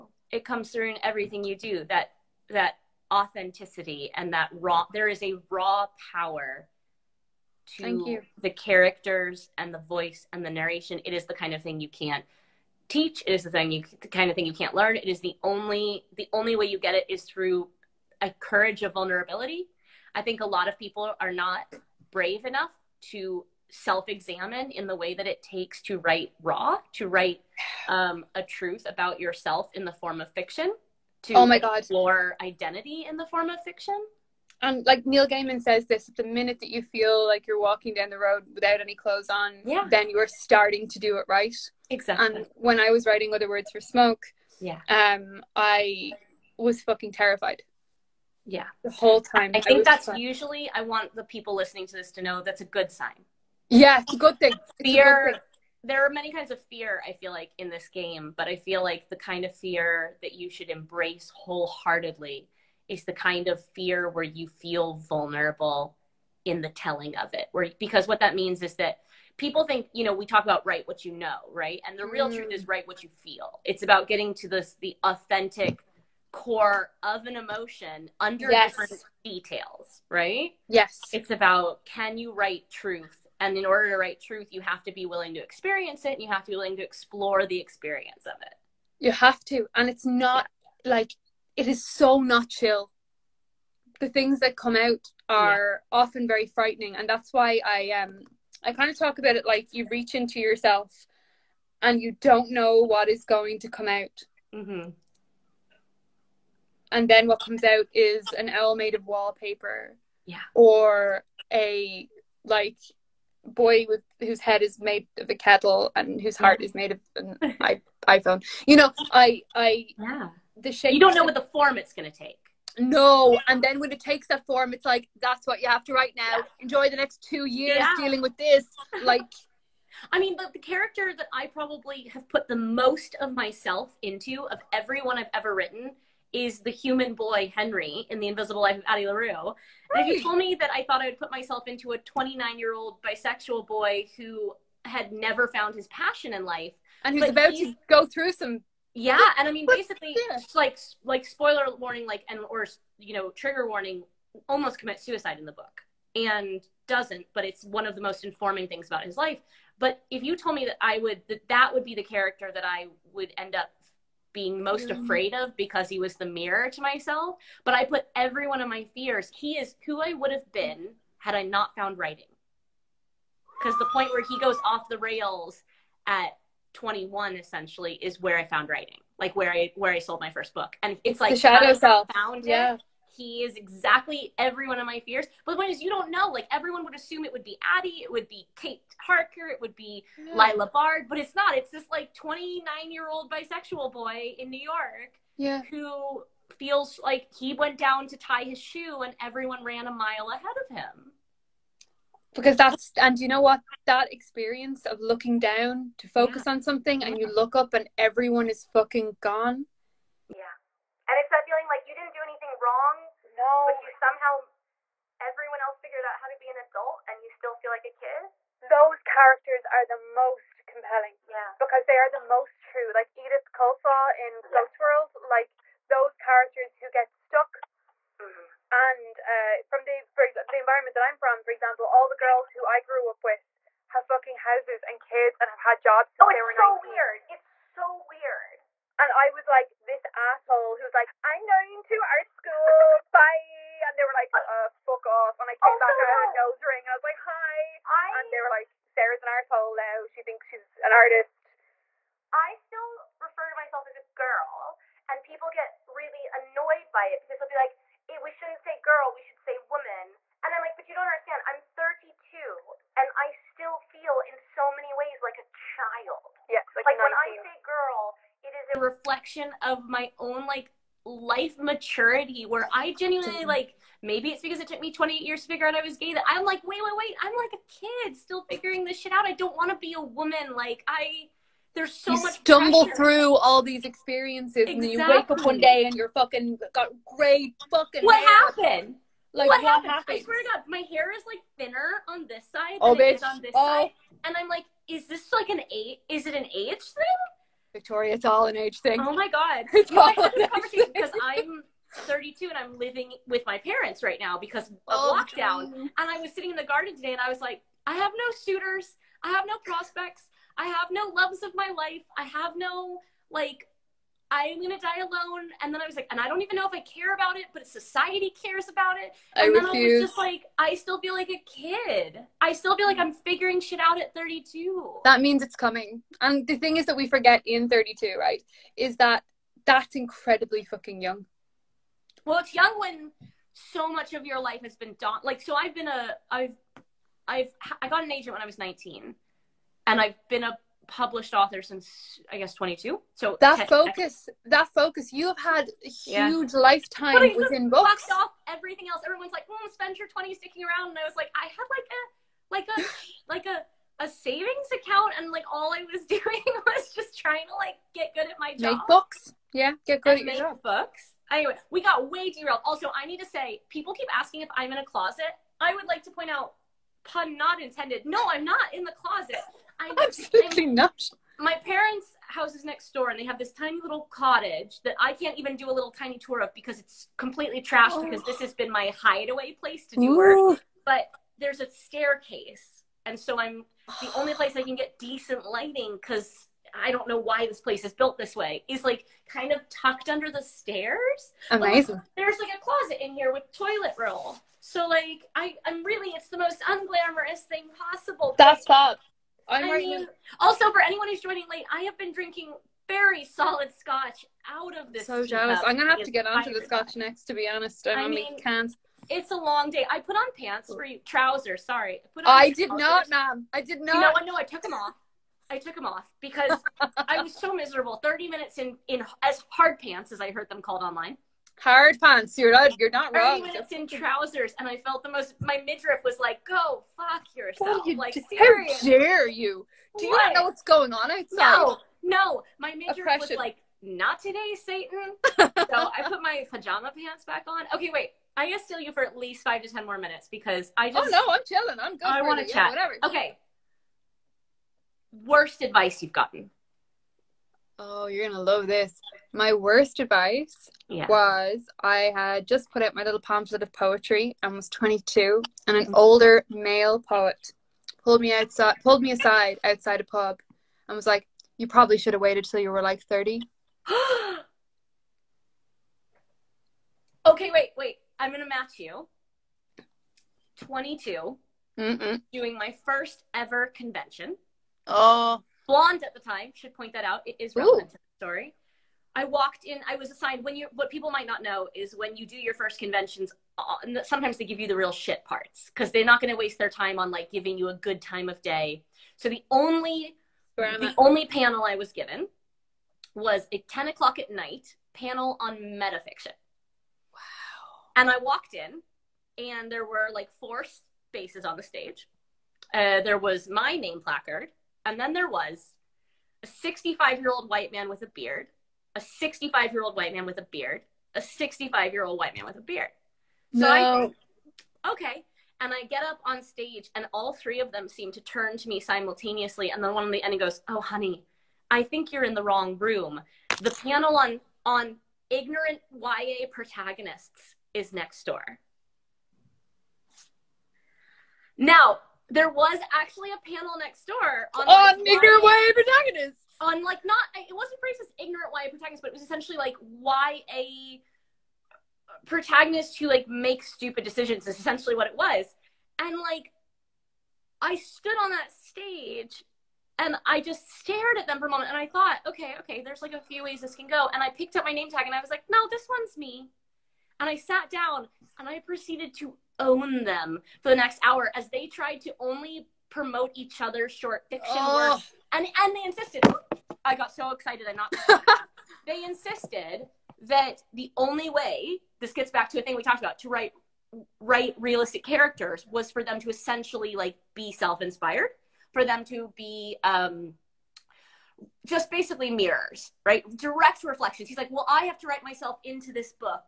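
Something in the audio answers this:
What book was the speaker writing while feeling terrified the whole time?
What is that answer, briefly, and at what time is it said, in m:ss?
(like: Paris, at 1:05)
Other Words for Smoke, at 0:43.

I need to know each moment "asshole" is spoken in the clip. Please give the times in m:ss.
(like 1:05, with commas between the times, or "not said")
4:00, 4:09.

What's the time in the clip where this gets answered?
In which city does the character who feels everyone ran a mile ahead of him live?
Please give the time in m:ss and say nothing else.
3:14.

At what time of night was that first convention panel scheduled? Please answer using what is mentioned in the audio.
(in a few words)
10 o'clock.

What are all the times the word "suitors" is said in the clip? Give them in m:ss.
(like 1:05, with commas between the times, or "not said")
5:08.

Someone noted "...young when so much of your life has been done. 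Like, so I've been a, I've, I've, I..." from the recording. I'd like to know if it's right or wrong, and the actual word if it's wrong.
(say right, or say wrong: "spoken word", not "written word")
right.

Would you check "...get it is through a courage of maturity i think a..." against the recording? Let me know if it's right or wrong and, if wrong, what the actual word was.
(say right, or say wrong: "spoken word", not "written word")
wrong: "vulnerability", not "maturity".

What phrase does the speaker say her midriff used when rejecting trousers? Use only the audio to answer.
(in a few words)
Not today, Satan.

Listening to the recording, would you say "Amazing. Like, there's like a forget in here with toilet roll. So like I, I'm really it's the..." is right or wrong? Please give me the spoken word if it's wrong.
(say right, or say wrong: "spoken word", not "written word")
wrong: "closet", not "forget".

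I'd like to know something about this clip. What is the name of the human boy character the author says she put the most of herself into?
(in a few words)
Henry.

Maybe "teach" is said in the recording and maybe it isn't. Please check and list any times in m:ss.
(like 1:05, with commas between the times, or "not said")
0:12.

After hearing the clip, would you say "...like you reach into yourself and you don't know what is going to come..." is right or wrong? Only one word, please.
right.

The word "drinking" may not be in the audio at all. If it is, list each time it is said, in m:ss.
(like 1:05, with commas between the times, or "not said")
6:42.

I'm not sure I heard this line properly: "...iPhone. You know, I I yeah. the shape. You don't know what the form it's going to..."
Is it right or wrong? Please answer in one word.
right.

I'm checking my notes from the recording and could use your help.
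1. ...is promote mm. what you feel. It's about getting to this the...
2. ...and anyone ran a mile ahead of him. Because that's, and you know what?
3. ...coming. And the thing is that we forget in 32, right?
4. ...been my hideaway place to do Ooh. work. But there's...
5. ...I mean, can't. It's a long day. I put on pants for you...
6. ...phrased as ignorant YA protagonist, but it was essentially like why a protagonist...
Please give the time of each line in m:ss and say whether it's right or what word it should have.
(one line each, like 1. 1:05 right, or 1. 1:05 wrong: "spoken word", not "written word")
1. 1:12 wrong: "write", not "promote"
2. 3:19 wrong: "everyone", not "anyone"
3. 5:25 right
4. 6:18 right
5. 6:48 right
6. 8:57 right.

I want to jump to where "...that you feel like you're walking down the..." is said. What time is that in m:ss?
0:36.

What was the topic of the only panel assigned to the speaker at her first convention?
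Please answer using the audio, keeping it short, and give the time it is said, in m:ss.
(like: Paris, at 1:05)
Metafiction, at 8:15.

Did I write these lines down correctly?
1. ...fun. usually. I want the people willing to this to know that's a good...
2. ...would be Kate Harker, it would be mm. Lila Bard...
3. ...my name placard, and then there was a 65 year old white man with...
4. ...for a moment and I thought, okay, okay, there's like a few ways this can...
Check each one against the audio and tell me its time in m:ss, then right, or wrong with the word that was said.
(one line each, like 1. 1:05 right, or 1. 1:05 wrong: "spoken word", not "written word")
1. 0:50 wrong: "listening", not "willing"
2. 3:08 right
3. 8:23 right
4. 9:11 right.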